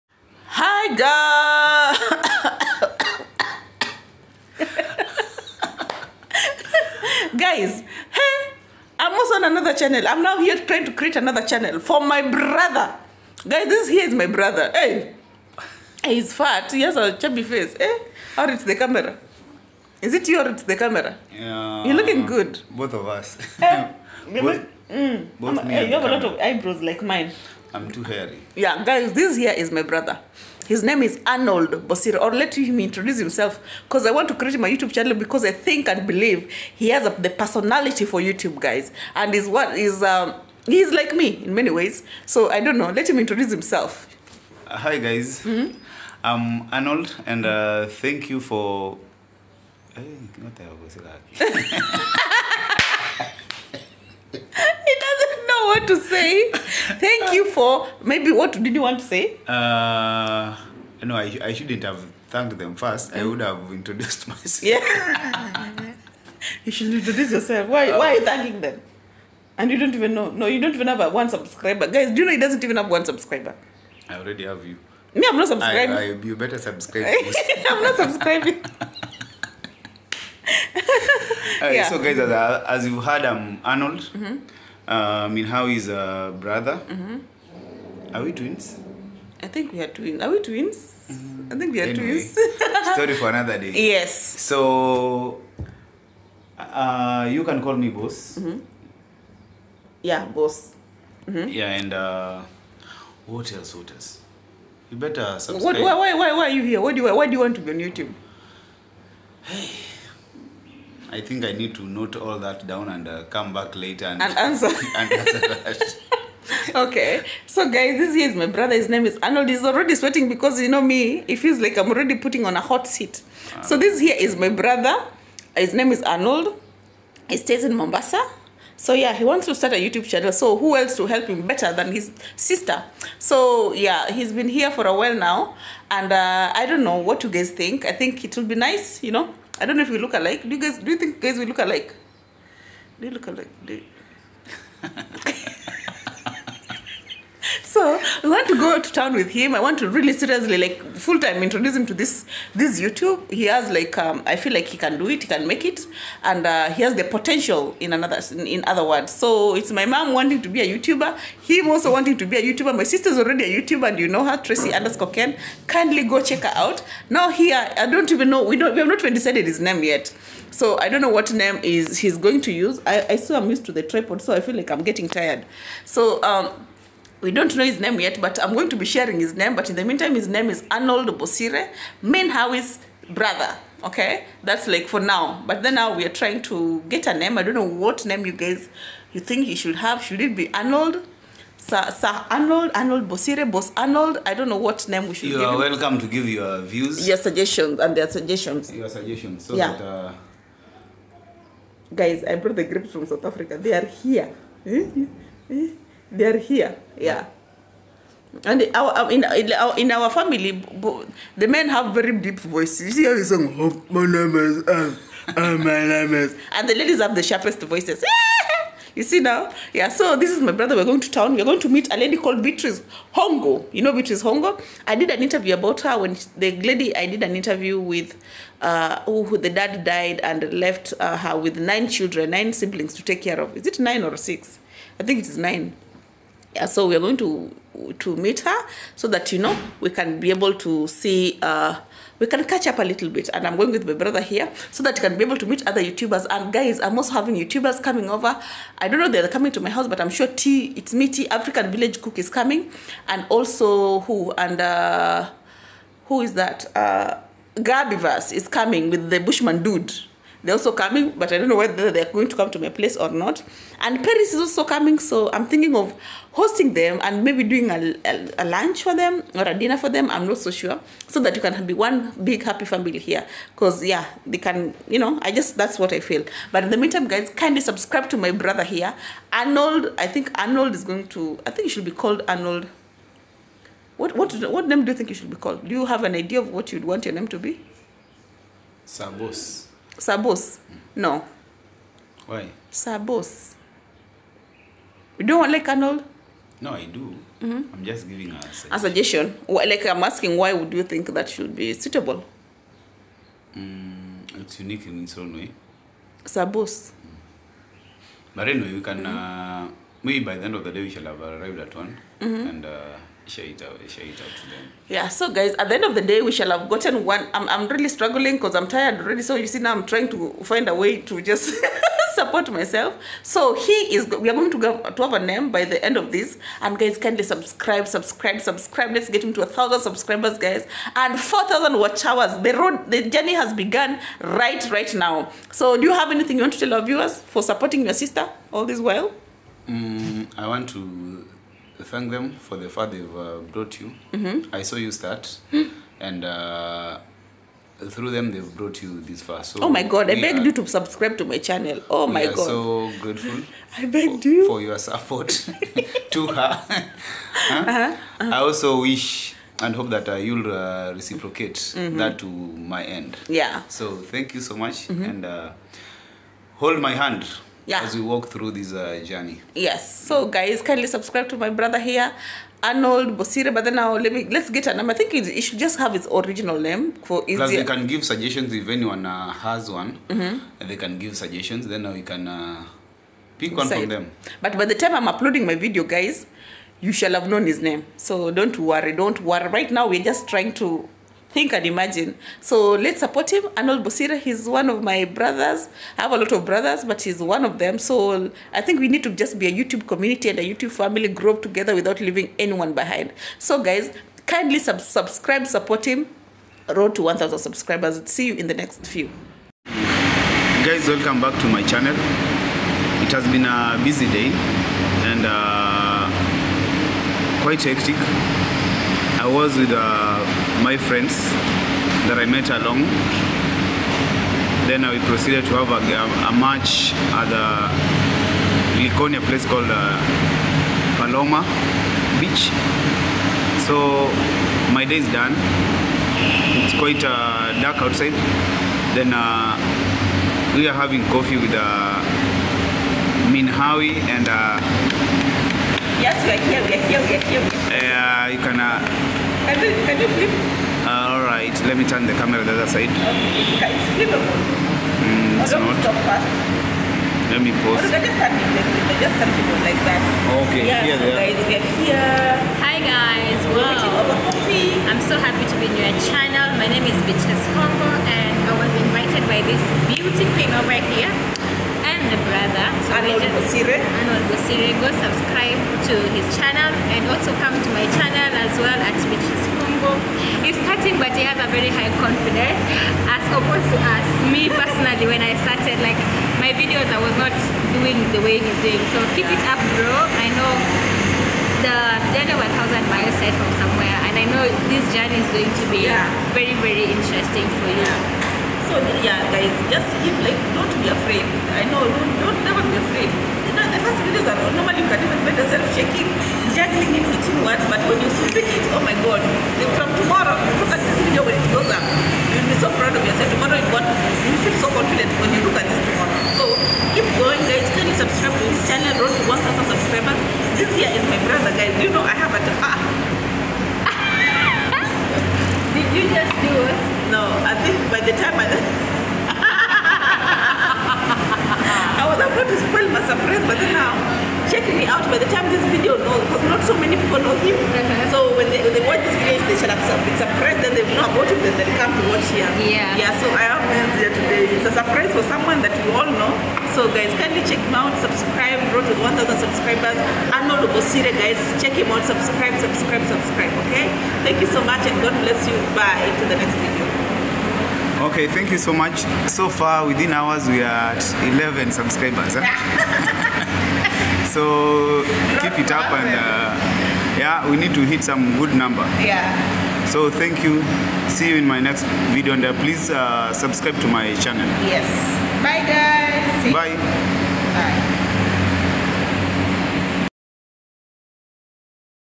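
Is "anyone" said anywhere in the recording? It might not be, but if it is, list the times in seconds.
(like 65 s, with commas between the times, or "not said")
378 s, 402 s.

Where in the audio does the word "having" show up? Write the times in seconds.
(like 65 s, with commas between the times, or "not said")
247 s, 440 s.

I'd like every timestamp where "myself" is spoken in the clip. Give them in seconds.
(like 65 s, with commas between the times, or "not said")
64 s, 322 s.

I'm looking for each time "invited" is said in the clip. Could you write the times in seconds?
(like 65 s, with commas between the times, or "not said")
468 s.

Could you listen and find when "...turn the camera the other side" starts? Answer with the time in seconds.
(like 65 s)
451 s.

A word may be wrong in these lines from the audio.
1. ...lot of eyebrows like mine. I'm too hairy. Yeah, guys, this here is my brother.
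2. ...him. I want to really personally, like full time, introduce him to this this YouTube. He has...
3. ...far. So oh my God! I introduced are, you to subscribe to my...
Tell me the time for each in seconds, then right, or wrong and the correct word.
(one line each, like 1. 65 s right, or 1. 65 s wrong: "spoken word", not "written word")
1. 26 s right
2. 149 s wrong: "seriously", not "personally"
3. 349 s wrong: "begged", not "introduced".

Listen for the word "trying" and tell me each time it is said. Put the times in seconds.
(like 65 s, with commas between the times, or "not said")
10 s, 186 s, 319 s, 390 s.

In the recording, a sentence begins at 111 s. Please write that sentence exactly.
I think I need to note all that down and uh, come back later and, and answer.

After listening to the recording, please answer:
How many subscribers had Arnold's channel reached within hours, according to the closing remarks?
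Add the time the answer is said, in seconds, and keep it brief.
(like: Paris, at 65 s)
11, at 561 s.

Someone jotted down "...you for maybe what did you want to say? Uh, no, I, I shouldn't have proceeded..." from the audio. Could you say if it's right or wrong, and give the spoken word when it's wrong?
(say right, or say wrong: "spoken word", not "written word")
wrong: "thanked", not "proceeded".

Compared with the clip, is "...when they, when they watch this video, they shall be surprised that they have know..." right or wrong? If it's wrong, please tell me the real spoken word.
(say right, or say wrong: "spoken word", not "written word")
right.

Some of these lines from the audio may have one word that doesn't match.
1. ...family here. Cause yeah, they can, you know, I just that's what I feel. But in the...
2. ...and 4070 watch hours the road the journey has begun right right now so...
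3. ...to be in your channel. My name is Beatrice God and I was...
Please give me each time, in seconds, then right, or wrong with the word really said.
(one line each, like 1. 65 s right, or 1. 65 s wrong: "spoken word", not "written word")
1. 272 s right
2. 330 s wrong: "4000", not "4070"
3. 465 s wrong: "Hongo", not "God".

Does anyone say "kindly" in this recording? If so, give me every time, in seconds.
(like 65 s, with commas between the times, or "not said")
165 s, 277 s, 326 s, 370 s, 404 s, 517 s, 547 s.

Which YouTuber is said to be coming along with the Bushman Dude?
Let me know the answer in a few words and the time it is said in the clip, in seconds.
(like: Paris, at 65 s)
Gabiverse, at 257 s.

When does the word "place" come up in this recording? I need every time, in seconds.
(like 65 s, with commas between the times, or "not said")
262 s, 429 s.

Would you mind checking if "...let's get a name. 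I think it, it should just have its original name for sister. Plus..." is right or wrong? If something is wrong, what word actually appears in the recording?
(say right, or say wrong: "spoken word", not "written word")
wrong: "easier", not "sister".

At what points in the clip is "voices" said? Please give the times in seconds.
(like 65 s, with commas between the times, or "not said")
212 s, 217 s.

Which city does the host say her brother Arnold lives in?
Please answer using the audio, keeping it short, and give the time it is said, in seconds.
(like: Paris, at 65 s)
Mombasa, at 127 s.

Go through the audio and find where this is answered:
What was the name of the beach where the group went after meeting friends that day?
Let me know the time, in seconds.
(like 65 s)
430 s.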